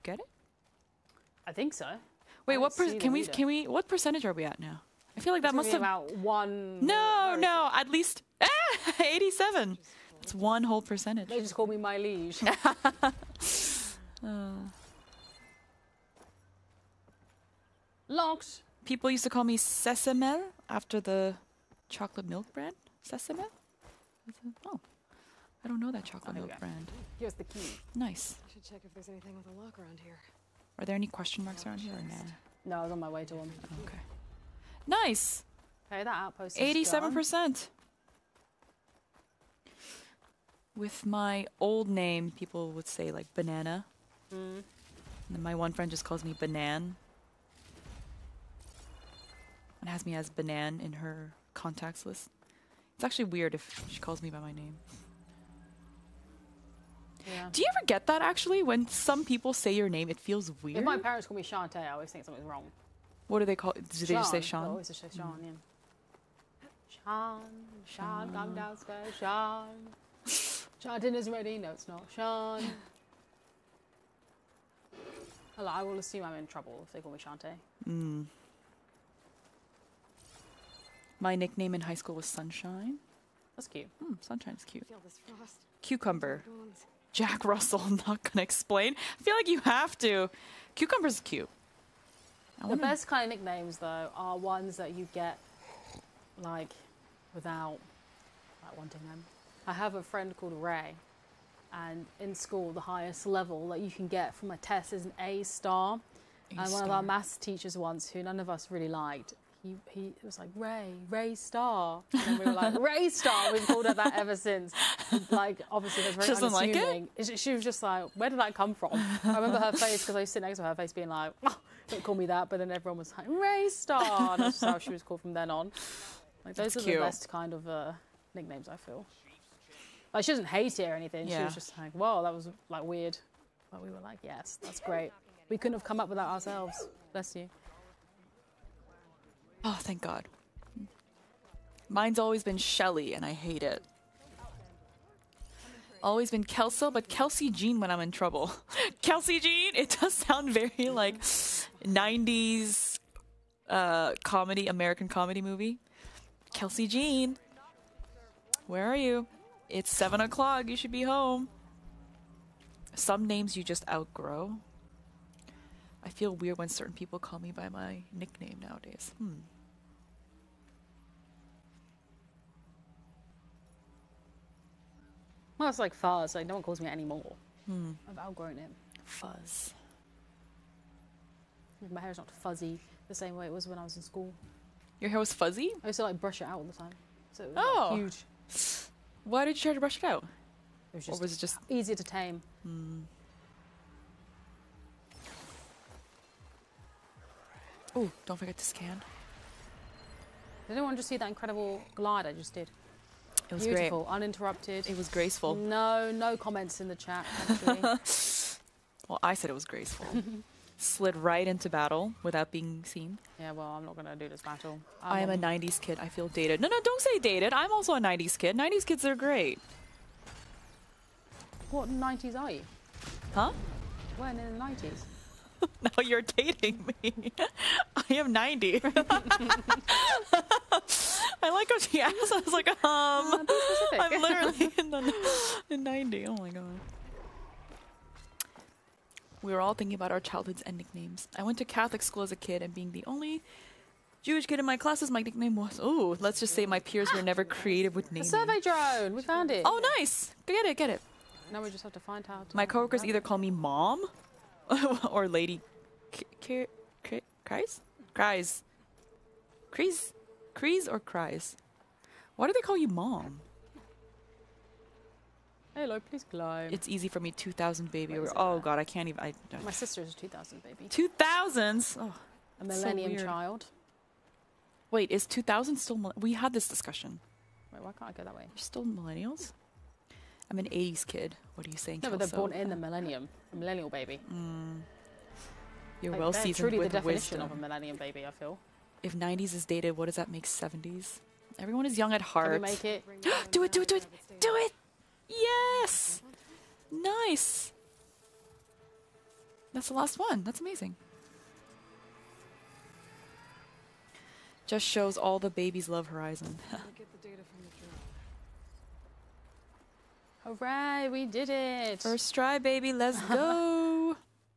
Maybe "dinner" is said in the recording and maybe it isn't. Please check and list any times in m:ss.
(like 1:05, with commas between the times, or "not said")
1:11.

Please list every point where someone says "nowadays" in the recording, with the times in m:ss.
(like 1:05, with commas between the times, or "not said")
2:48.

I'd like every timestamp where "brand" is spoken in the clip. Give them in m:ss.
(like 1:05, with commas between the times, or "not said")
0:22, 0:26.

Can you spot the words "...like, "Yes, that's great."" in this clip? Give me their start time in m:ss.
2:13.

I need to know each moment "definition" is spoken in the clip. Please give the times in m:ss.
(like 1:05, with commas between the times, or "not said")
4:46.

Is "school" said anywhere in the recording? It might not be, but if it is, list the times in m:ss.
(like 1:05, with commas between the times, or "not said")
1:21, 1:42, 3:04, 4:02.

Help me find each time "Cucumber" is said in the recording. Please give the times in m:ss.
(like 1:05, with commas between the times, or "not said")
1:25, 1:30.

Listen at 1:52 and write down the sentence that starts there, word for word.
And we were like, Ray Star.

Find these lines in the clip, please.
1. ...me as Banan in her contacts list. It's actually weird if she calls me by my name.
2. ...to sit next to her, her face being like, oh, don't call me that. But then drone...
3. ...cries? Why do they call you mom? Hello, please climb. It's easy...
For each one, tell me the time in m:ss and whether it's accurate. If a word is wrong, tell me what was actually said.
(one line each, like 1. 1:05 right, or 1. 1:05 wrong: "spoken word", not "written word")
1. 0:50 right
2. 2:00 wrong: "everyone", not "drone"
3. 4:20 right.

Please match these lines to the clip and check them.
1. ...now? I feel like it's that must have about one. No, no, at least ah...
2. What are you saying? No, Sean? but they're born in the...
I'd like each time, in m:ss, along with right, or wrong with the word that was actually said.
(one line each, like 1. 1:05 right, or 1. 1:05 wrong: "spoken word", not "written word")
1. 0:04 right
2. 4:41 wrong: "Kelso", not "Sean".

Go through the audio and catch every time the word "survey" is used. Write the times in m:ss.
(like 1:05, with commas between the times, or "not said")
4:08.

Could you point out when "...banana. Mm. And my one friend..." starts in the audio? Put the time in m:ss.
0:43.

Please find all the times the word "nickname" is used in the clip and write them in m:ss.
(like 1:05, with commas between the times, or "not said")
1:21, 1:33, 2:08, 2:48, 4:00, 4:05.